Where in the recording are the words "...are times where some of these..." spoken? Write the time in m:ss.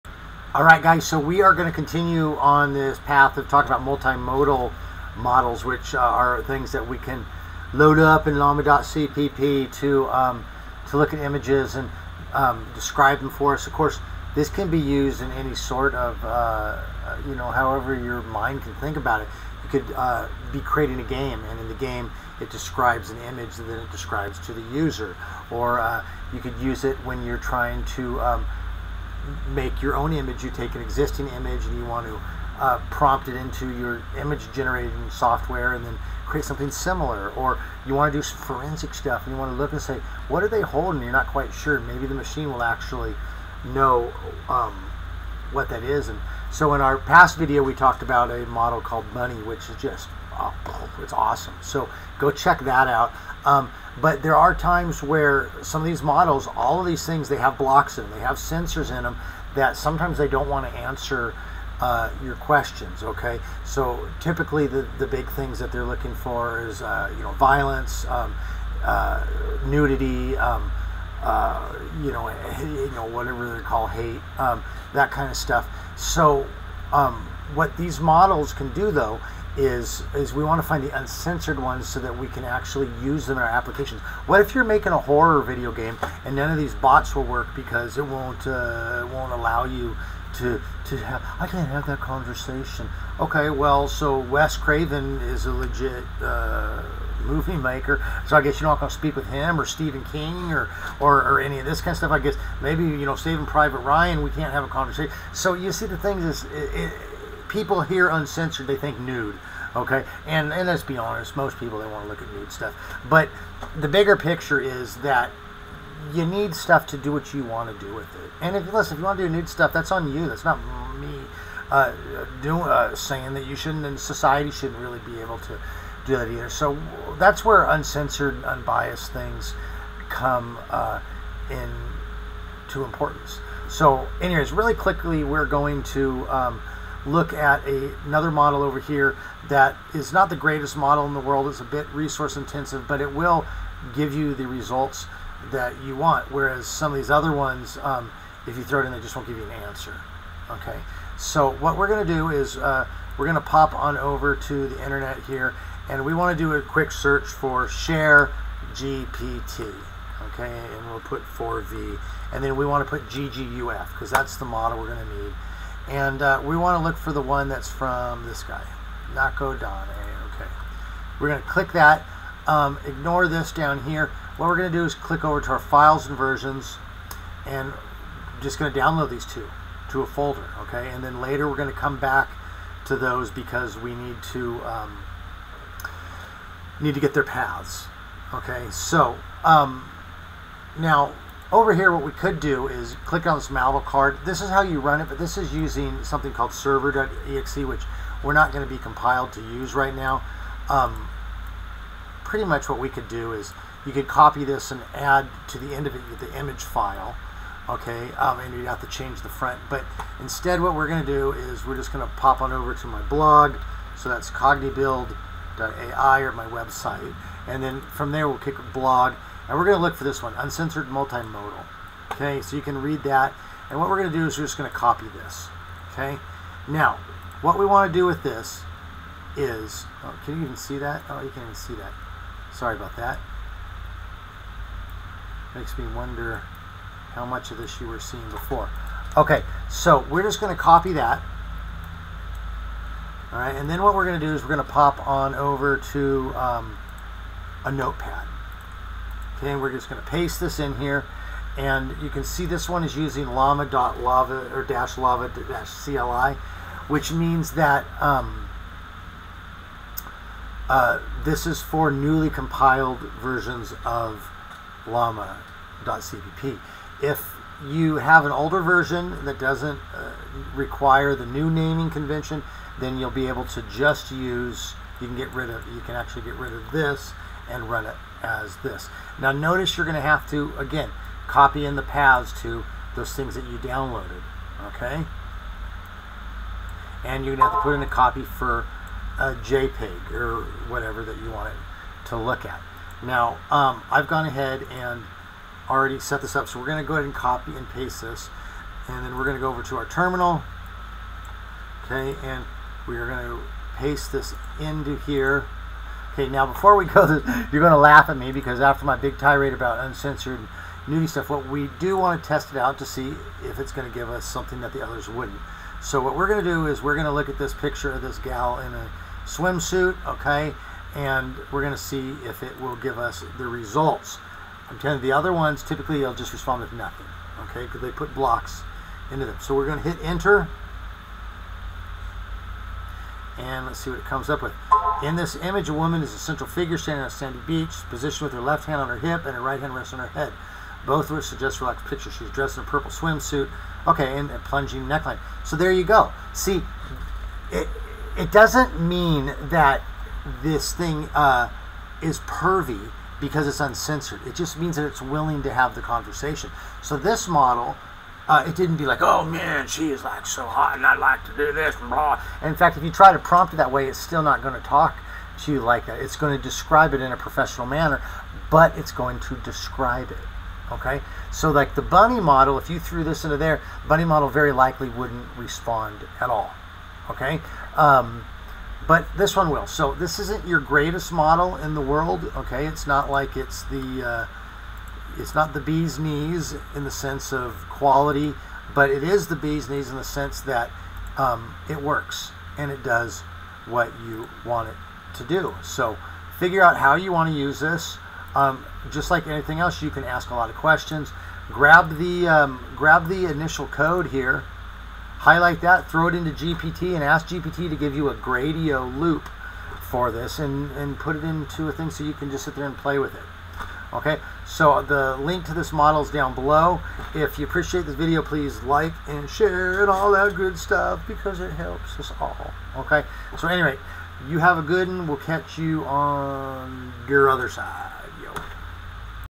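0:54.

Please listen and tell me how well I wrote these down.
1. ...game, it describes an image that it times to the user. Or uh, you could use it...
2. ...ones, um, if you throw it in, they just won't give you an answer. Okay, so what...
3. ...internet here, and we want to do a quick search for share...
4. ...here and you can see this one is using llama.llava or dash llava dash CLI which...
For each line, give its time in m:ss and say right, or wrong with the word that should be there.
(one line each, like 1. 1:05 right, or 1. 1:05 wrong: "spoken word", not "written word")
1. 0:21 wrong: "describes", not "times"
2. 2:27 right
3. 2:34 right
4. 4:10 right.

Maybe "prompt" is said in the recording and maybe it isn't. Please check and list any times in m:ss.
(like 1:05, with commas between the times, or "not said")
0:32, 6:03.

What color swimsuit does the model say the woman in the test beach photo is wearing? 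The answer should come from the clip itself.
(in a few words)
Purple.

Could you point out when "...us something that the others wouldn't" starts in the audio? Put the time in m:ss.
5:14.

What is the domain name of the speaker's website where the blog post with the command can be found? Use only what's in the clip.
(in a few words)
cognibuild.ai.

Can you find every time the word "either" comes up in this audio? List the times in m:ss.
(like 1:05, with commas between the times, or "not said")
2:06.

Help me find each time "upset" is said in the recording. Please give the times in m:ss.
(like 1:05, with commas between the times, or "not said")
not said.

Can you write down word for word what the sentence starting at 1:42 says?
I guess maybe you know Saving Private Ryan.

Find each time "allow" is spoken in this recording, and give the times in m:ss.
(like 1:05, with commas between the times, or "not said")
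1:29.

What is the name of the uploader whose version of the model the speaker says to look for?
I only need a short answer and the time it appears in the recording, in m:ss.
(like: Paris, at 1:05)
Nako, at 2:49.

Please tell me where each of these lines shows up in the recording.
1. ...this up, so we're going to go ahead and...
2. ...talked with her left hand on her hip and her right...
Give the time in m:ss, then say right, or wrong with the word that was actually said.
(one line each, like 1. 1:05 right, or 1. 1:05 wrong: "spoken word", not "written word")
1. 4:56 right
2. 5:37 wrong: "positioned", not "talked".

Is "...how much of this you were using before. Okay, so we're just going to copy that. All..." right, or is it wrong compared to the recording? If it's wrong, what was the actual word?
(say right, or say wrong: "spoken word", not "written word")
wrong: "seeing", not "using".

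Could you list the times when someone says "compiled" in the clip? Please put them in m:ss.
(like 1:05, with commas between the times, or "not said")
3:18, 4:22.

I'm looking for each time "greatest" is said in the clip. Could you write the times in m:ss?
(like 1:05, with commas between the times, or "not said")
2:20, 6:20.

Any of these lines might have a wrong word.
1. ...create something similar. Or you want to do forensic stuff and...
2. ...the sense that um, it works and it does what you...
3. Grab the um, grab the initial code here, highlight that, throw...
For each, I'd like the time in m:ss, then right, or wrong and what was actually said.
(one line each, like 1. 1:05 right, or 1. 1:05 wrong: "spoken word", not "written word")
1. 0:36 right
2. 6:29 right
3. 6:41 right.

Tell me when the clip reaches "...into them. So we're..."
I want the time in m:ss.
5:29.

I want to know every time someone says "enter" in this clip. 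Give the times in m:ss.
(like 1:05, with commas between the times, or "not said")
5:30.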